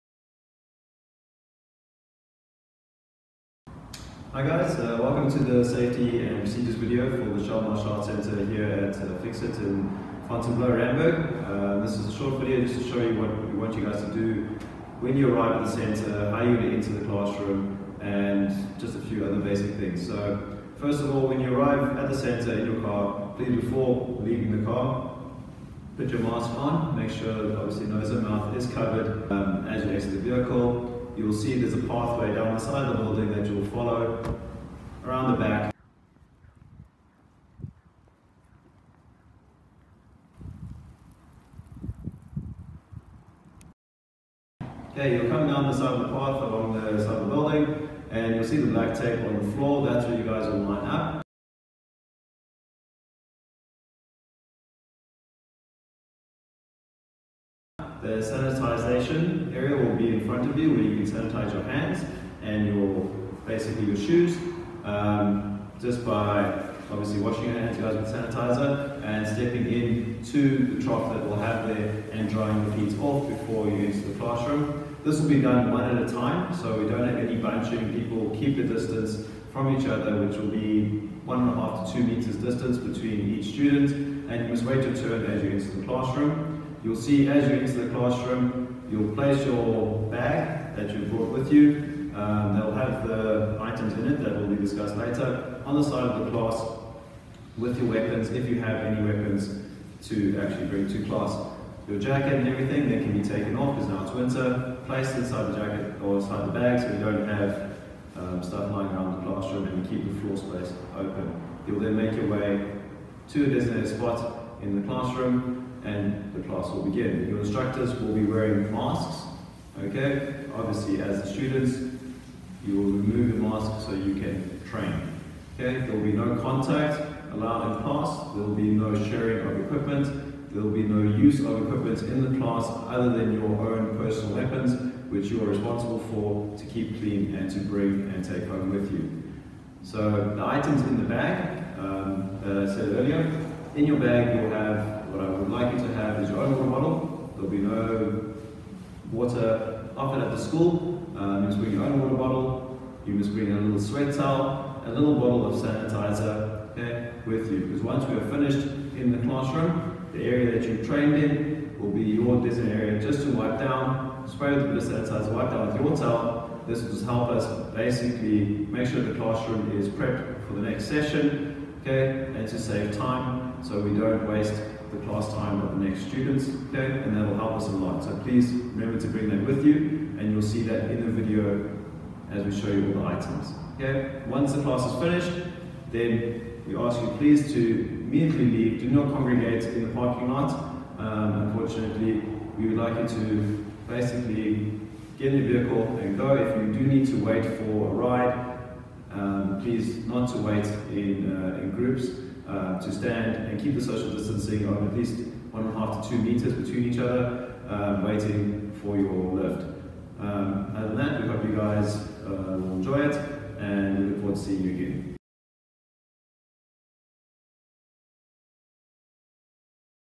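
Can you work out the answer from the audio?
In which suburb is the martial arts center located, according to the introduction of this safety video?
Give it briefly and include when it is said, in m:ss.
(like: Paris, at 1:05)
Fontainebleau, Randburg, at 0:10.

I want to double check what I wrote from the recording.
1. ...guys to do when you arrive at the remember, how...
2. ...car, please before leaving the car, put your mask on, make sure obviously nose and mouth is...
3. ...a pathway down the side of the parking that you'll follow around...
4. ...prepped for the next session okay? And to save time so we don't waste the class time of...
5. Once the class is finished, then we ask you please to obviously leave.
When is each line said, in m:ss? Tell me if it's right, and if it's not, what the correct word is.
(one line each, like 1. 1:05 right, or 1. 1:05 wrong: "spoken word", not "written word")
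1. 0:13 wrong: "center", not "remember"
2. 0:22 right
3. 0:31 wrong: "building", not "parking"
4. 2:49 right
5. 3:04 wrong: "immediately", not "obviously".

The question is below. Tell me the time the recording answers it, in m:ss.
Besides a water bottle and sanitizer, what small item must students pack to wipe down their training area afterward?
2:33.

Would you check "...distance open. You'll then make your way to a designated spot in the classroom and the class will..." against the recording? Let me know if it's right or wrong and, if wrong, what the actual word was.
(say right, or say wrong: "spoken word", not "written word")
wrong: "space", not "distance".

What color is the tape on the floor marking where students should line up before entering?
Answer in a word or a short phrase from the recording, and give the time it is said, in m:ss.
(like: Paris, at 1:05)
Black, at 0:48.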